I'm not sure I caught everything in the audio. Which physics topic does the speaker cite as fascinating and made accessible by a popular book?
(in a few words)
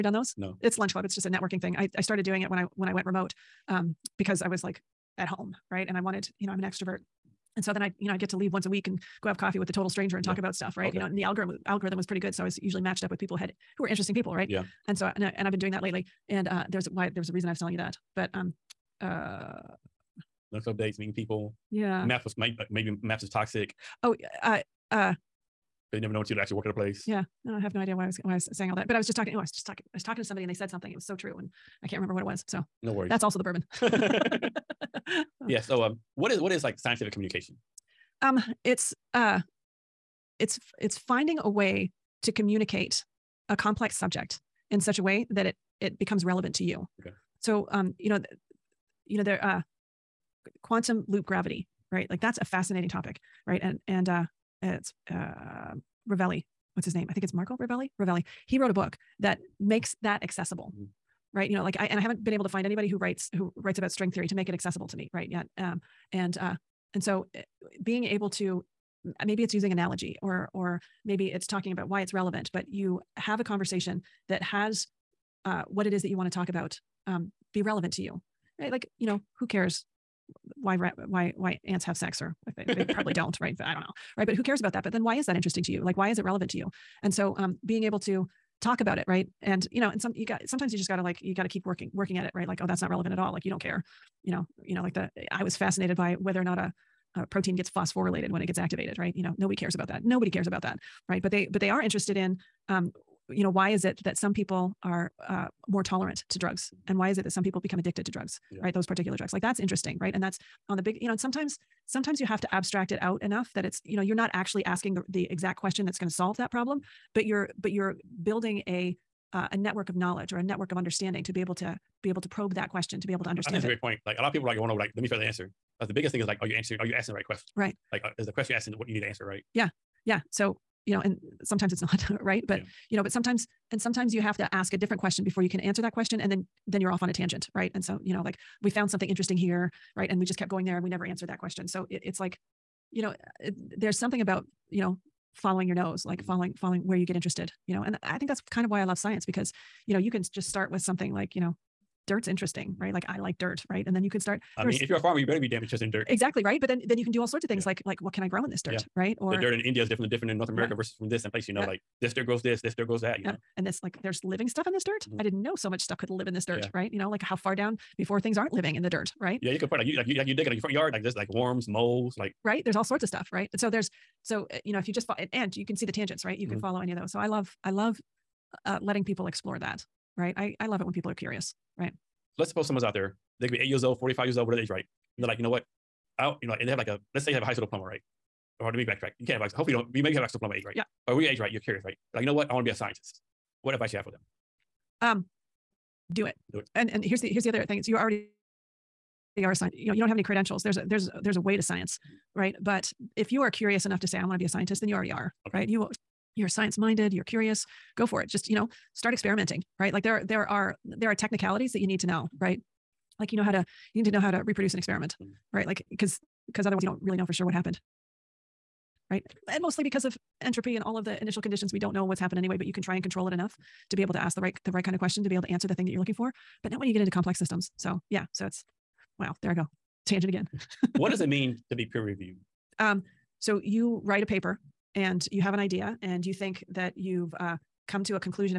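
quantum loop gravity.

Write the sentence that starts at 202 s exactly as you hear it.
But if you are curious enough to say, I want to be a scientist, then you already are, okay.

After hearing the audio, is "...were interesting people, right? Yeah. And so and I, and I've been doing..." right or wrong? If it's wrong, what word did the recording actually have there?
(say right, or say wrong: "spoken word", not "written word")
right.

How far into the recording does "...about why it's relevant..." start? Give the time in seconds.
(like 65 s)
71 s.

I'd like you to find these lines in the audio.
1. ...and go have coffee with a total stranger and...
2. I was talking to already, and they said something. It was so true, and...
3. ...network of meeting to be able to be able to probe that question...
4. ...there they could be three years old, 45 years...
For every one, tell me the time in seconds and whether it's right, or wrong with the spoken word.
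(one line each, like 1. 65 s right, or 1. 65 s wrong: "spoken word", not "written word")
1. 8 s right
2. 29 s wrong: "somebody", not "already"
3. 120 s wrong: "understanding", not "meeting"
4. 182 s wrong: "eight", not "three".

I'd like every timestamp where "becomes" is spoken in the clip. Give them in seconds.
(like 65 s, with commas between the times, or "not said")
45 s, 107 s.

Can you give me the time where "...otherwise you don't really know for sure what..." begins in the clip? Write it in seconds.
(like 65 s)
216 s.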